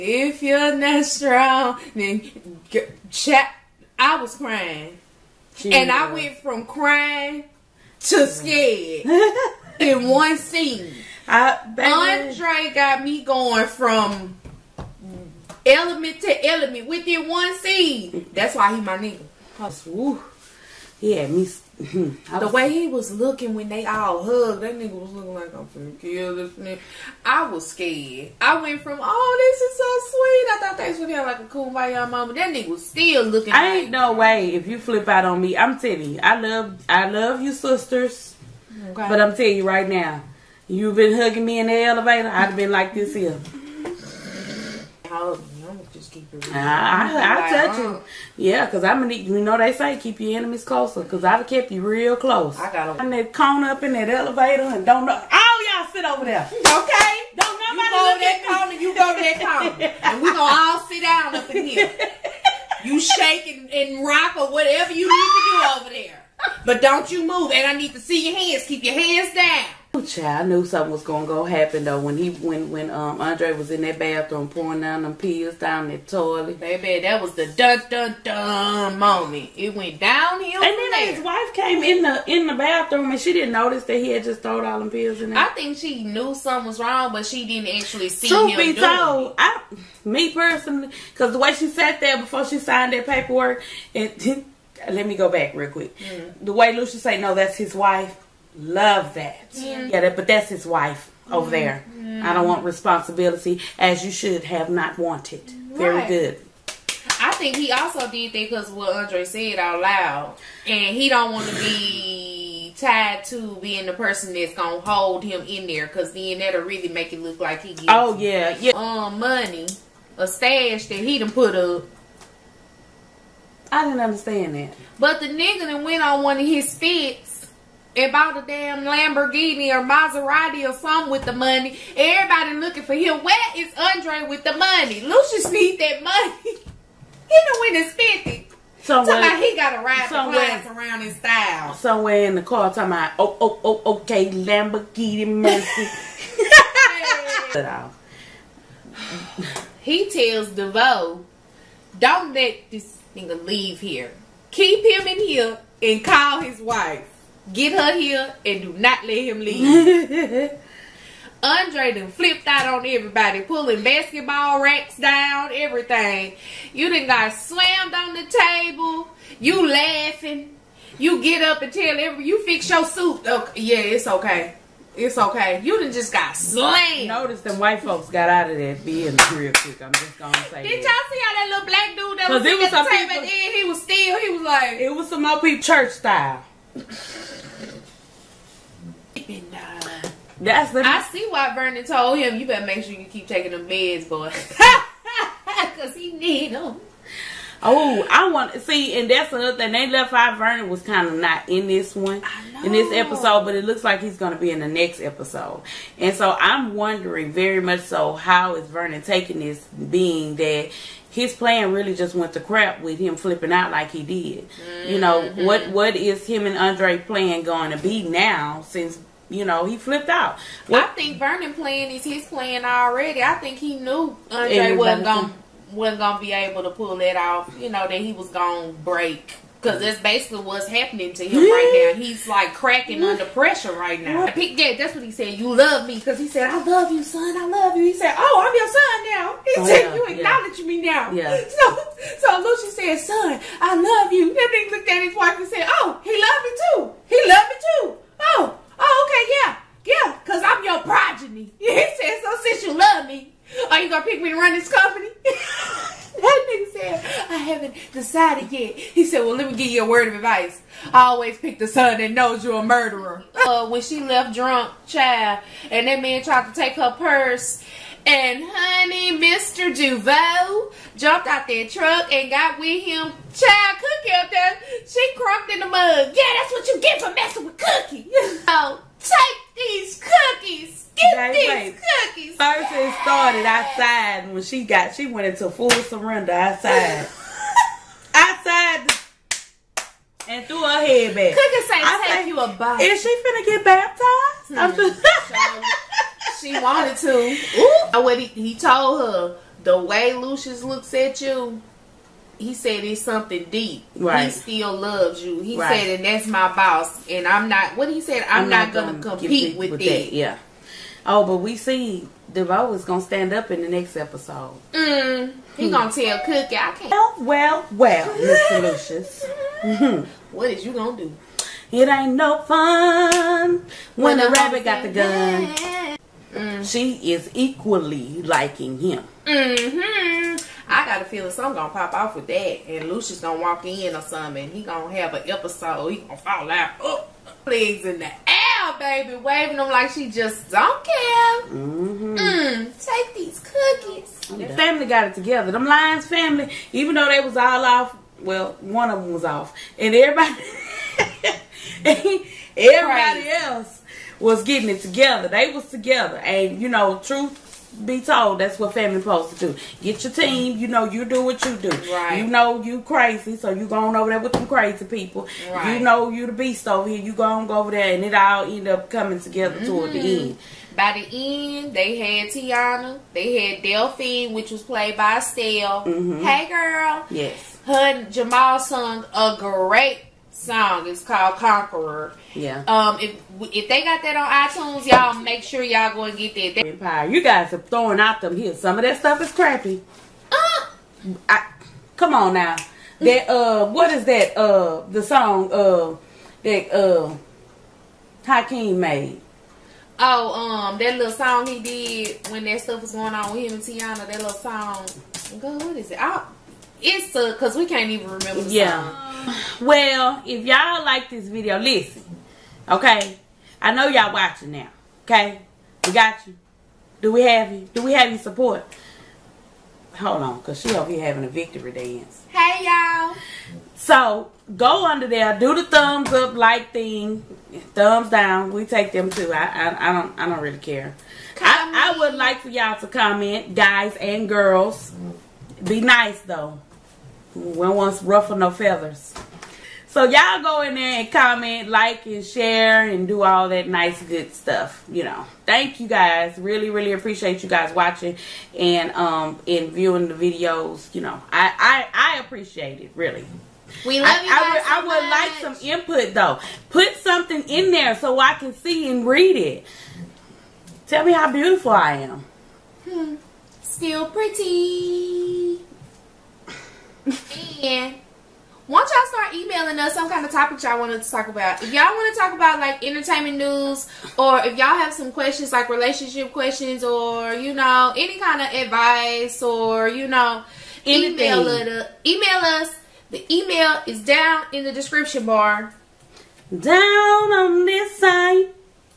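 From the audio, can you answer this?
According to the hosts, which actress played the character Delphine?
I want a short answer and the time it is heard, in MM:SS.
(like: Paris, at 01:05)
Estelle, at 06:15.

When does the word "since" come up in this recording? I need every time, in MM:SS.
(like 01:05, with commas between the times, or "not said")
03:38, 04:12.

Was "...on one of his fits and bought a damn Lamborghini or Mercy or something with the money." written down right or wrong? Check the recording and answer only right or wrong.
wrong.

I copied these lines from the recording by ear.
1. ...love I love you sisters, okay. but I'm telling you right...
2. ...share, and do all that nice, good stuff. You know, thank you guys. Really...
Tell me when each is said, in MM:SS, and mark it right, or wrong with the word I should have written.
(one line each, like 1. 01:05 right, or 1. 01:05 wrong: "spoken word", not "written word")
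1. 00:36 right
2. 07:22 right.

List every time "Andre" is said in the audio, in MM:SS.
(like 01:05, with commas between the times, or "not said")
00:11, 01:13, 01:48, 02:13, 02:41, 03:36, 03:44.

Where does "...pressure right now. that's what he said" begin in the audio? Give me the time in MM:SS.
03:53.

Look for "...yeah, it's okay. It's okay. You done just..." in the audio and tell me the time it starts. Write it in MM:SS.
02:53.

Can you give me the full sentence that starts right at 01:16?
Baby, that was the dun dun dun moment.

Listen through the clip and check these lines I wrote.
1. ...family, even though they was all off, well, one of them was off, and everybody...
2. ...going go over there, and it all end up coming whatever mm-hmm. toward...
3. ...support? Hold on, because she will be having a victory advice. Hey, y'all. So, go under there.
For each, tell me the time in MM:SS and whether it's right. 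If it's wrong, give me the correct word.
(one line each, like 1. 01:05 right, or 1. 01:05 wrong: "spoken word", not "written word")
1. 05:46 right
2. 06:07 wrong: "together", not "whatever"
3. 06:58 wrong: "dance", not "advice".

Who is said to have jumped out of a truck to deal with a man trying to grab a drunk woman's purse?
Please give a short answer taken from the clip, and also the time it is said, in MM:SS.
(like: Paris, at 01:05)
Mr. Duval, at 04:29.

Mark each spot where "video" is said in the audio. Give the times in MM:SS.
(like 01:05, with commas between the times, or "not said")
06:51, 07:30.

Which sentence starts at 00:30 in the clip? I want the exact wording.
I thought they was gonna have like a kumbaya mama.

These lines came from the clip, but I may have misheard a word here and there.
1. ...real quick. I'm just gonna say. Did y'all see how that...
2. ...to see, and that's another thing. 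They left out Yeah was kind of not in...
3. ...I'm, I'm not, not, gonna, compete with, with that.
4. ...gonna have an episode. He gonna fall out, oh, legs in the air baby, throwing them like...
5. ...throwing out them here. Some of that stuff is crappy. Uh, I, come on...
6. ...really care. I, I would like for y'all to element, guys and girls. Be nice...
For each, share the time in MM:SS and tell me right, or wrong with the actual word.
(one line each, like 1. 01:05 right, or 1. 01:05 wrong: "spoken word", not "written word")
1. 02:59 right
2. 03:18 wrong: "Vernon", not "Yeah"
3. 05:08 right
4. 05:34 wrong: "waving", not "throwing"
5. 06:27 right
6. 07:10 wrong: "comment", not "element".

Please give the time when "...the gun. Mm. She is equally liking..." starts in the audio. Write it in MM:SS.
05:24.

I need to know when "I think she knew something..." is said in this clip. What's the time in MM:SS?
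01:25.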